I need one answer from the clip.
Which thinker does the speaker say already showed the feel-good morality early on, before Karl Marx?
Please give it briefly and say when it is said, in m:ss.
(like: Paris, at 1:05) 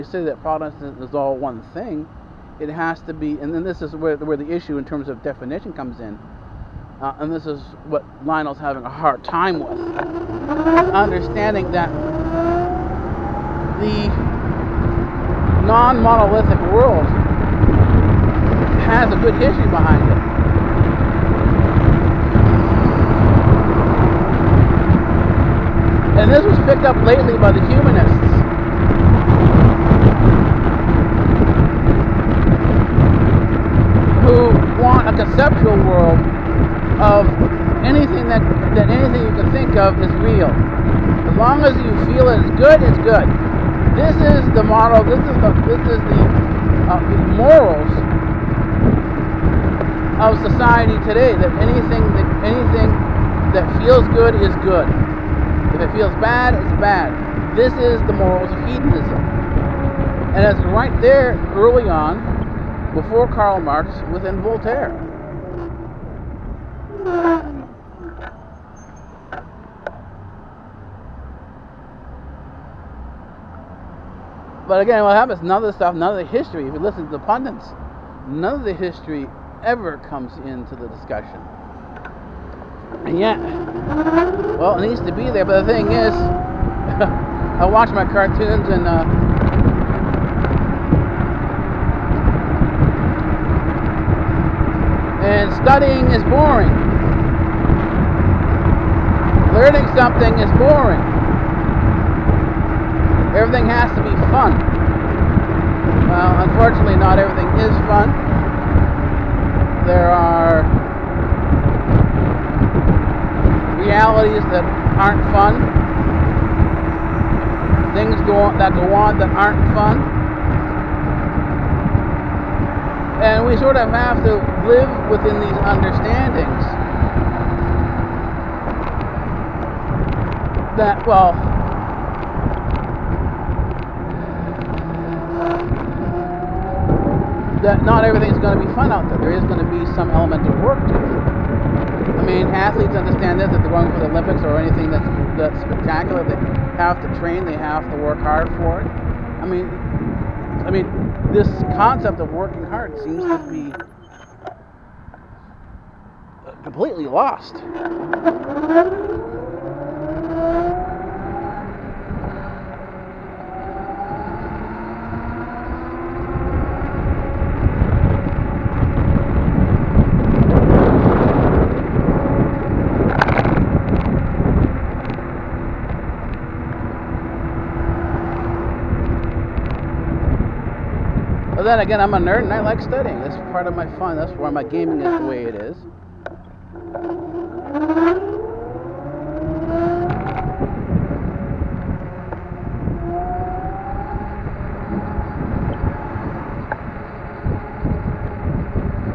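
Voltaire, at 1:04.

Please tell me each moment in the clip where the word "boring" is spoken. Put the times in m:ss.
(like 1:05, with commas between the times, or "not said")
1:36, 1:40.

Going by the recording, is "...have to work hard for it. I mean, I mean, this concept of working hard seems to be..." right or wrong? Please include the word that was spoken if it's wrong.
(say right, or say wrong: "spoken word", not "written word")
right.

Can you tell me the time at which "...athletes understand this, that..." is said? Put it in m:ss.
2:22.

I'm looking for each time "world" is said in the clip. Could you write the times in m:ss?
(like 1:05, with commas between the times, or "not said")
0:16, 0:35.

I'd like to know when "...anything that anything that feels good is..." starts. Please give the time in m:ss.
0:51.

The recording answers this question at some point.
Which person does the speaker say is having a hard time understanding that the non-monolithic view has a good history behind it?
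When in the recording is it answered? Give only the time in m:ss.
0:08.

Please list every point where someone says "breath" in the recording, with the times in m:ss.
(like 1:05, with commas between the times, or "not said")
not said.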